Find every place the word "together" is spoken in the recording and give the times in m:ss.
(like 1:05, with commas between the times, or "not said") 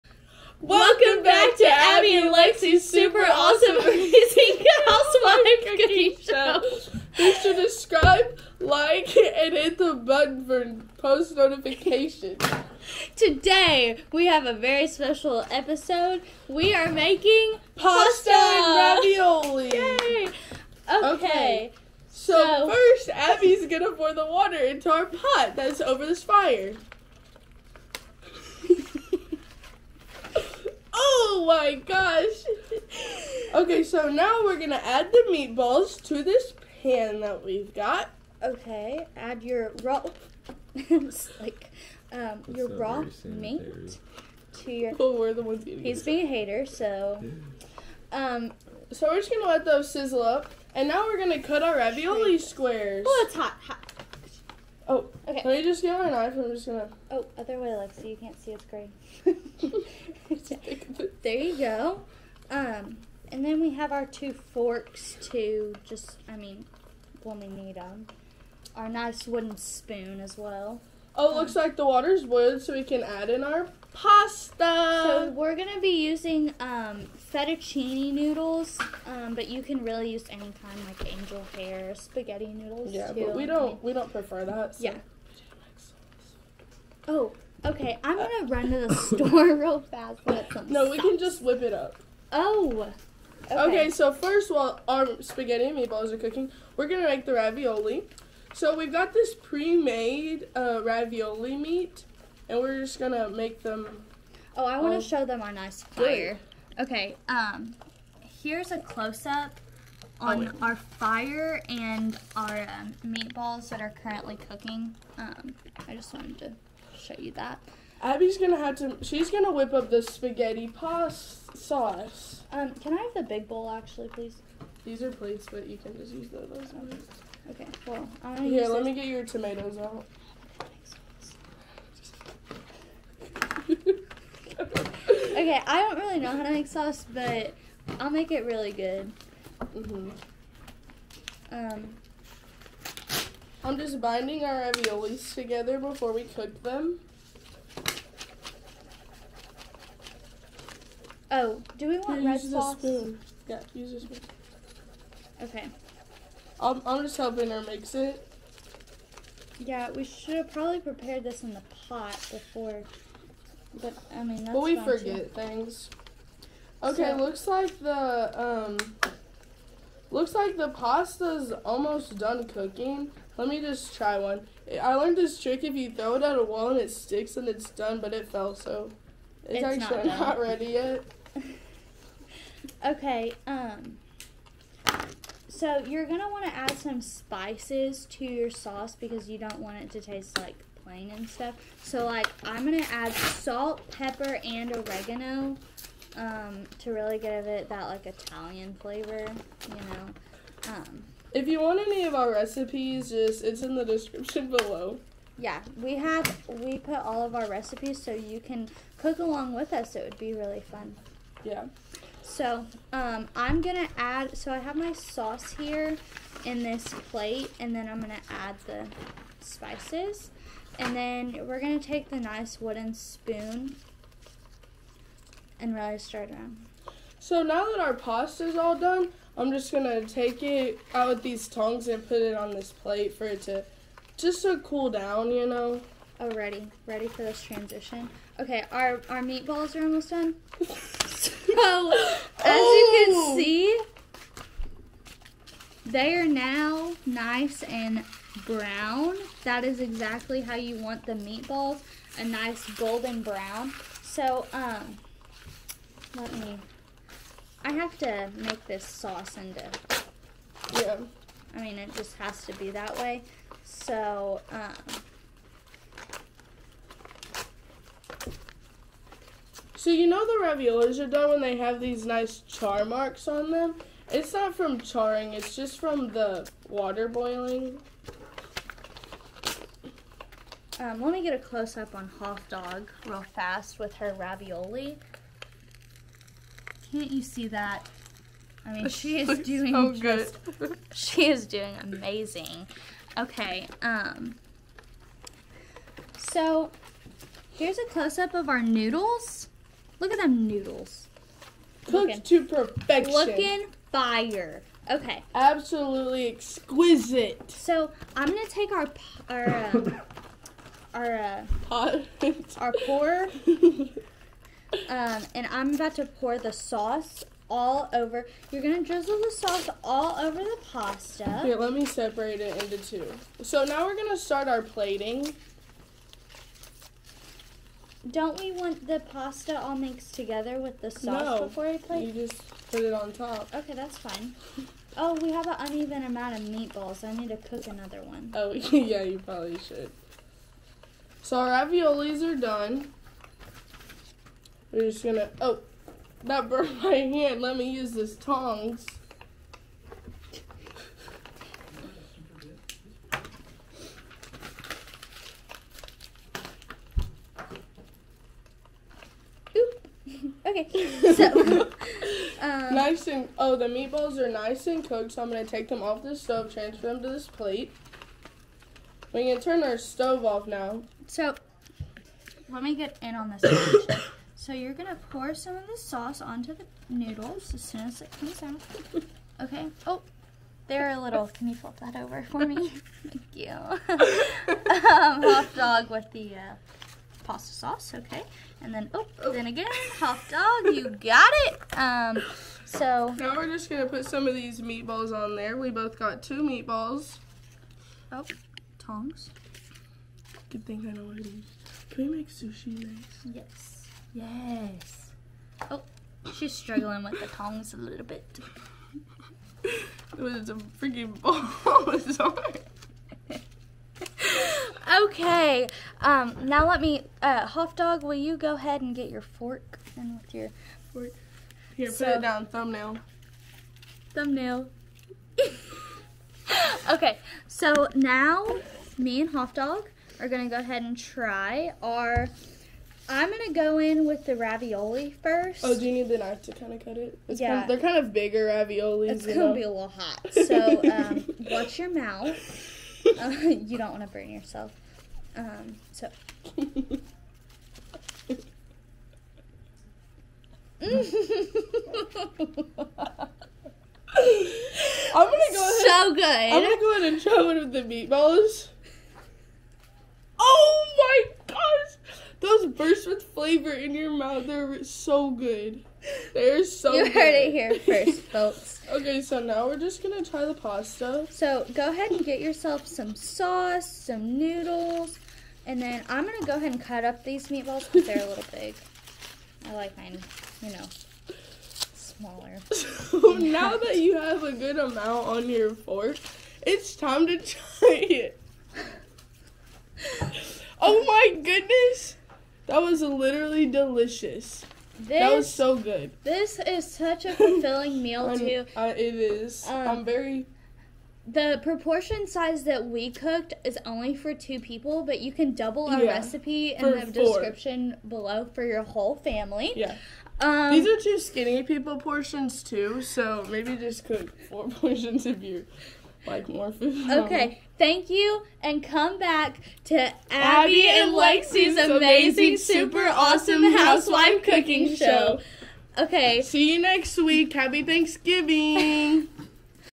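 2:25, 5:30.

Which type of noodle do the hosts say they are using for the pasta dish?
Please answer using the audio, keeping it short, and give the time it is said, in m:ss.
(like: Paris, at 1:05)
Fettuccine, at 1:17.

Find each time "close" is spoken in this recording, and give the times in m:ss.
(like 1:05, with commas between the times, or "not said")
1:48, 4:41, 4:57.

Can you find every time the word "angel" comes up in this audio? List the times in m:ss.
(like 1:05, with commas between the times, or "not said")
1:21.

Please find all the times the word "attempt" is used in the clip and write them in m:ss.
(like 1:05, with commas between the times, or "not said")
not said.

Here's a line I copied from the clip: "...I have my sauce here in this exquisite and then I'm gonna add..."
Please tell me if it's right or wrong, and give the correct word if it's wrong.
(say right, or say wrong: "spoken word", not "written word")
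wrong: "plate", not "exquisite".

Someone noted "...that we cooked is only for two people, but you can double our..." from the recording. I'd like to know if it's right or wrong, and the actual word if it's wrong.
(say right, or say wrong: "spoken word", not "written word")
right.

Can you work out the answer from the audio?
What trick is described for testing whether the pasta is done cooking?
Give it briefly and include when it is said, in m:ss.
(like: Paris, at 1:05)
Throw it at a wall, at 2:55.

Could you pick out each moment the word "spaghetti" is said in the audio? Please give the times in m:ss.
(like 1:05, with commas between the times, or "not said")
1:21, 1:35, 2:00.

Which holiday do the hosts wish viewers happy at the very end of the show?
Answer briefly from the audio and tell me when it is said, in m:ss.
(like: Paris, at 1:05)
Thanksgiving, at 8:47.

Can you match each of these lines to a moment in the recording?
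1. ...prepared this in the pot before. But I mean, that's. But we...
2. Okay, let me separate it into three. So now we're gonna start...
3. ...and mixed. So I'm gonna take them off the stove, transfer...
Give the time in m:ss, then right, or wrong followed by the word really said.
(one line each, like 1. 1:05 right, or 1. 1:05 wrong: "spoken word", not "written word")
1. 2:40 right
2. 5:21 wrong: "two", not "three"
3. 6:04 wrong: "cooked", not "mixed".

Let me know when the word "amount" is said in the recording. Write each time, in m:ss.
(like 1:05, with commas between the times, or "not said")
5:36, 8:04.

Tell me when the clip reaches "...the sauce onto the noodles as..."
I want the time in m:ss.
6:15.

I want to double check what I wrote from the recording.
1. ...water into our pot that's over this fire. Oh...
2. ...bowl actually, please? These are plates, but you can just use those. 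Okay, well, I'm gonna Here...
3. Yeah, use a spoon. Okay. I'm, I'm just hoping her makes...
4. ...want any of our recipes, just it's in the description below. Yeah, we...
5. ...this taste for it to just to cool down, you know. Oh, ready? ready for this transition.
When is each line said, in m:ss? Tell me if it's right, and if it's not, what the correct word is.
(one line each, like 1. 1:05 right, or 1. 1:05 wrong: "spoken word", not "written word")
1. 0:24 right
2. 2:03 right
3. 2:33 right
4. 3:21 right
5. 3:52 wrong: "plate", not "taste".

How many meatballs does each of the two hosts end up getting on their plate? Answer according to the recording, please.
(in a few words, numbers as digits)
2.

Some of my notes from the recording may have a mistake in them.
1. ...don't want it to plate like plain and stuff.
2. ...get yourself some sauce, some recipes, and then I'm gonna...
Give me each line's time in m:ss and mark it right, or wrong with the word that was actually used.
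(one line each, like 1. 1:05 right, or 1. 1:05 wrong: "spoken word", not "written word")
1. 3:09 wrong: "taste", not "plate"
2. 7:52 wrong: "noodles", not "recipes".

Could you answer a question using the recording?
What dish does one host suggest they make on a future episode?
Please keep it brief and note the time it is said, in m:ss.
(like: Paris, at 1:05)
Sushi, at 6:42.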